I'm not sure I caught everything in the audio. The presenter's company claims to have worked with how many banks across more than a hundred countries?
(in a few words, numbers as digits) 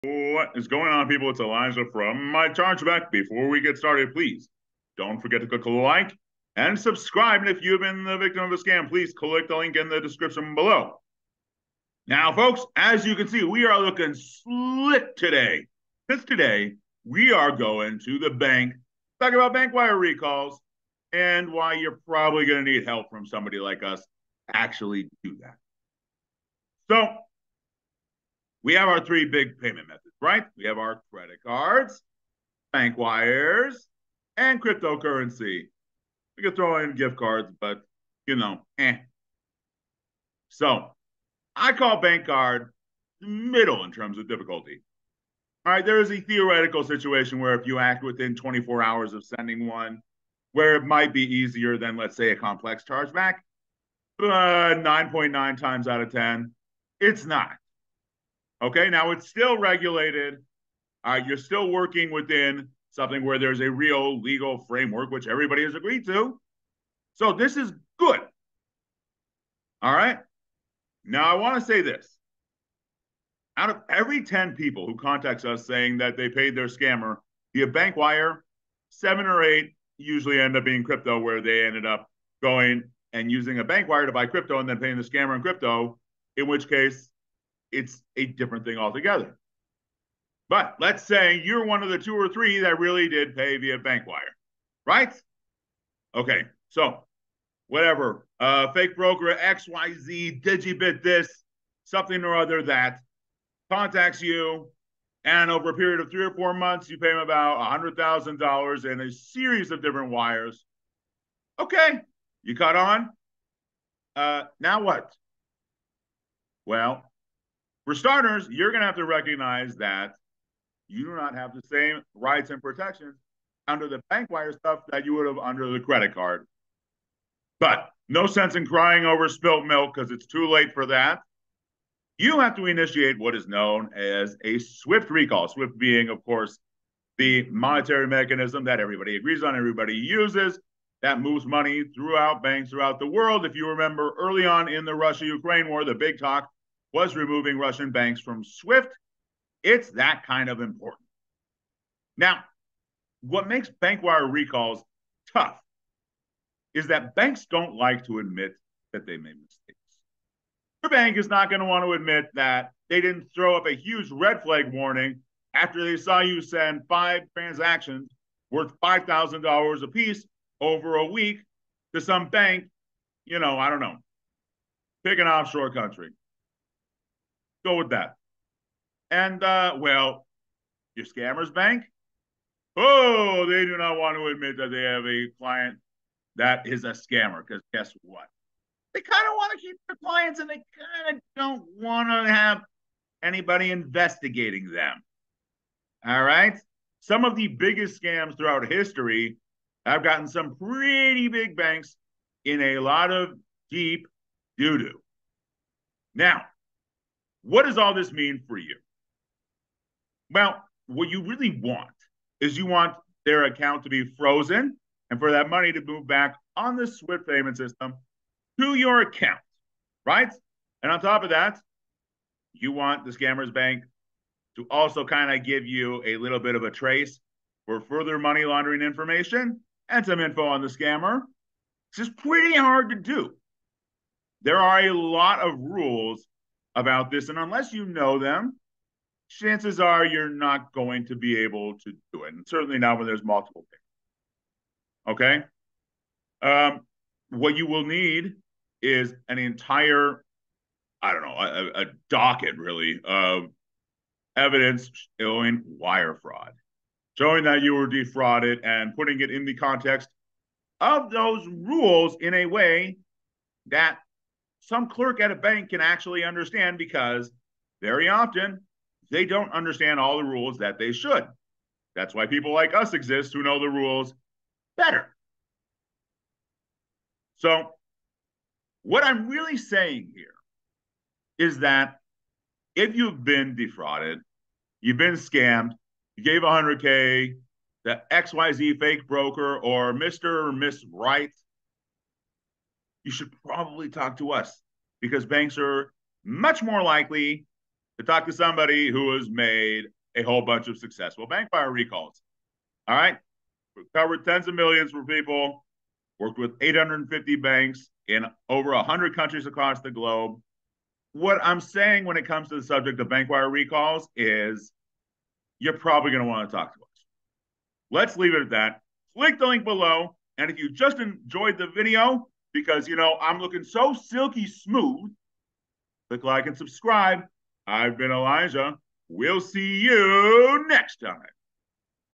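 850.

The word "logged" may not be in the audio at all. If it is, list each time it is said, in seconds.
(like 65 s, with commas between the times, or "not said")
not said.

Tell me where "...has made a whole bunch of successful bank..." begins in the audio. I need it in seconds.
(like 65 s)
299 s.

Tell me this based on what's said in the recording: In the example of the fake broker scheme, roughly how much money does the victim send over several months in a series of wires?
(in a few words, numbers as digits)
$100,000.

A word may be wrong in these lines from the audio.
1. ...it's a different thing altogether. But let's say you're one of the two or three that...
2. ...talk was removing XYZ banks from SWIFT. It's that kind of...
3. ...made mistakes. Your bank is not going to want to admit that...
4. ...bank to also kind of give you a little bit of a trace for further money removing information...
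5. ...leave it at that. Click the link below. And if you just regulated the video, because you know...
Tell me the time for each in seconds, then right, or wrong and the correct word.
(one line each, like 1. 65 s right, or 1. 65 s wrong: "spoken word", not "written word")
1. 87 s right
2. 146 s wrong: "Russian", not "XYZ"
3. 159 s right
4. 223 s wrong: "laundering", not "removing"
5. 318 s wrong: "enjoyed", not "regulated".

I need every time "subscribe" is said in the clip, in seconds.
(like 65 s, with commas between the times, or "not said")
6 s, 326 s.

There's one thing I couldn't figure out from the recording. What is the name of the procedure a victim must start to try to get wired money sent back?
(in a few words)
SWIFT recall.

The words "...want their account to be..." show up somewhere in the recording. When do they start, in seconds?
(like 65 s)
212 s.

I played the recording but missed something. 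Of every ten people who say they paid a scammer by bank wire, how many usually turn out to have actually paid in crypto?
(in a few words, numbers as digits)
7 or 8.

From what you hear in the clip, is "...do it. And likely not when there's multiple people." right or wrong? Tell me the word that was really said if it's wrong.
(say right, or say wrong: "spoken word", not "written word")
wrong: "certainly", not "likely".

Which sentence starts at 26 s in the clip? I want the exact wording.
So, we have our three big payment methods, right?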